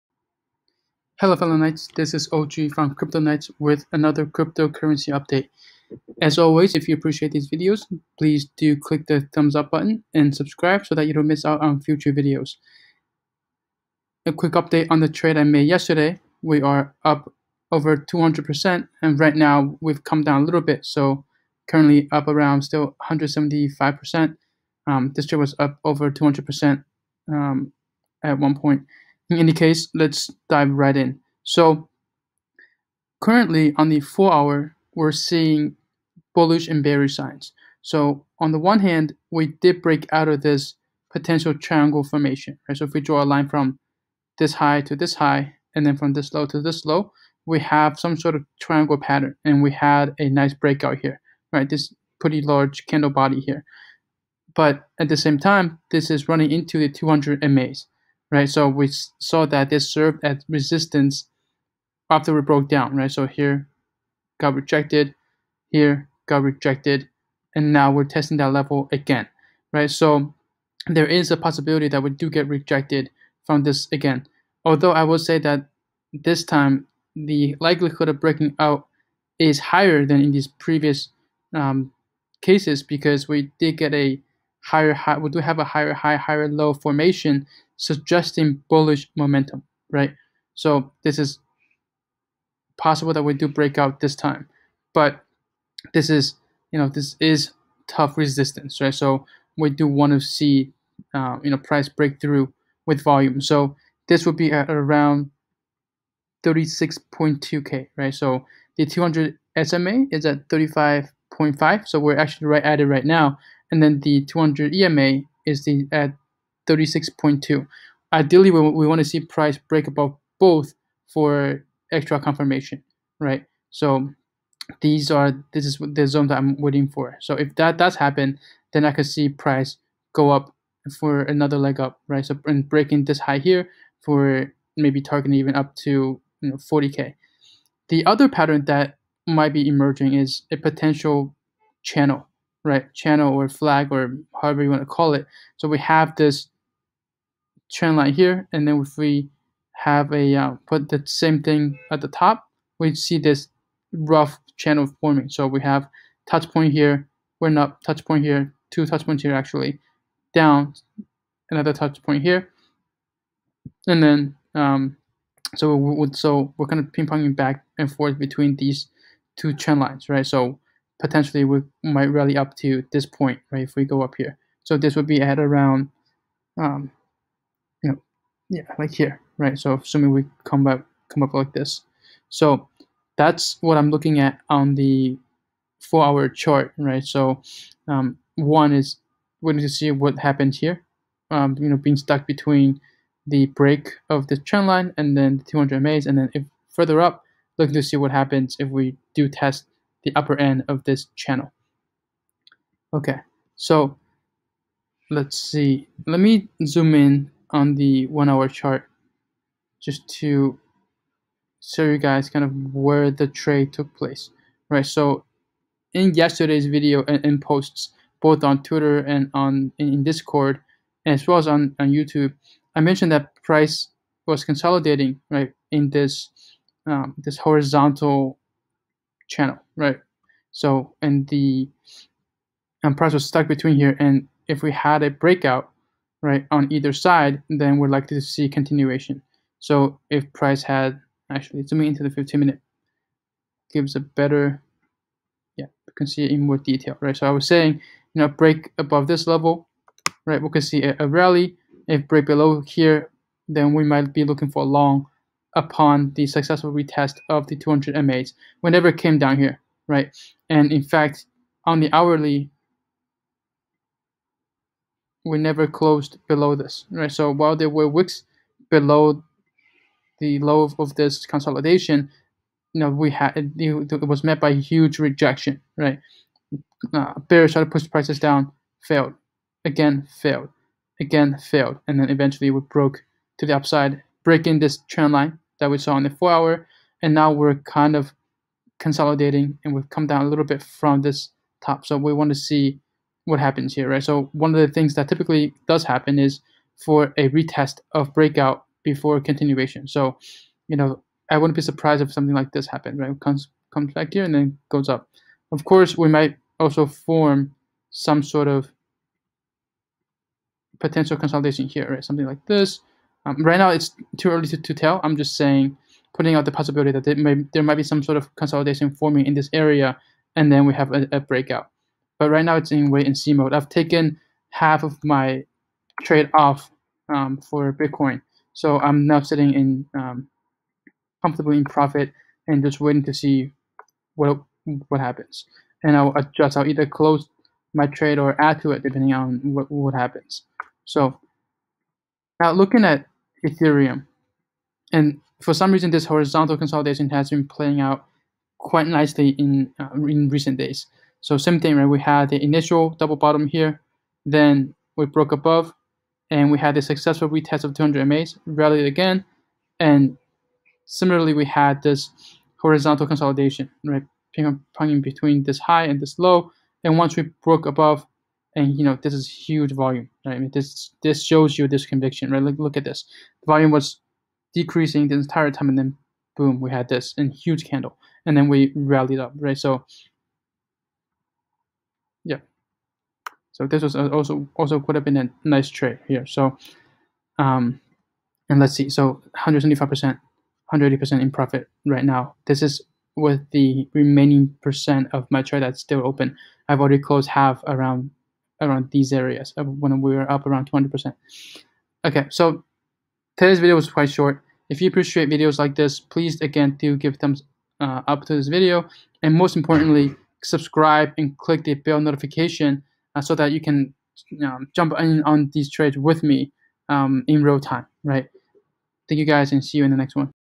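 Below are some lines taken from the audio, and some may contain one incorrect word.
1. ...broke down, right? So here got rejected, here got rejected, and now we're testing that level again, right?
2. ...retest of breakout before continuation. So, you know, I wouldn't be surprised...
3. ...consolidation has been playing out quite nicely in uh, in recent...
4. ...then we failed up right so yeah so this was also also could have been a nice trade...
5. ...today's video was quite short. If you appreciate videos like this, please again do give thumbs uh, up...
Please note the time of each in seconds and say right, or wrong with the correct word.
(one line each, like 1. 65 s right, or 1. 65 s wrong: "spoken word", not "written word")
1. 62 s right
2. 297 s right
3. 346 s right
4. 378 s wrong: "rallied", not "failed"
5. 403 s right.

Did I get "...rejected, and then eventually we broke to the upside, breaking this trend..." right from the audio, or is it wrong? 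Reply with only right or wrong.
wrong.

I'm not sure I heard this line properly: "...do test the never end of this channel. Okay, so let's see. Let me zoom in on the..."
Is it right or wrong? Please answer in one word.
wrong.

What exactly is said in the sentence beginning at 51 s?
This pretty large candle body here.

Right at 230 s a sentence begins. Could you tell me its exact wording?
So, and the and um, price was stuck between here.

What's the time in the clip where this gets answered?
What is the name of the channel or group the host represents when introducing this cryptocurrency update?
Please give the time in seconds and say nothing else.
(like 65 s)
2 s.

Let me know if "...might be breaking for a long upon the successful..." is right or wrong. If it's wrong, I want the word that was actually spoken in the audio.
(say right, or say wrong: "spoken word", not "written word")
wrong: "looking", not "breaking".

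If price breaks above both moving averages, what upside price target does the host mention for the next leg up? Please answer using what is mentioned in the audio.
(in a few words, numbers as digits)
40k.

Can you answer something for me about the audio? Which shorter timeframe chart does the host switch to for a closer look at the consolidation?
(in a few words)
15 minute.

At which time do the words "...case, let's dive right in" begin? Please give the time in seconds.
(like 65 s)
29 s.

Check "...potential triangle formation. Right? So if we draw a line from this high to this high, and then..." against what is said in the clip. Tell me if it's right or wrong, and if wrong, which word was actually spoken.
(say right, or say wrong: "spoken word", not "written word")
right.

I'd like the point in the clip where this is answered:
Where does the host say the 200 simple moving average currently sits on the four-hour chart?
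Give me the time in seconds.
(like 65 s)
110 s.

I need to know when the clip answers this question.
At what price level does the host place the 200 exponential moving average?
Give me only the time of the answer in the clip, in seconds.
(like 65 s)
116 s.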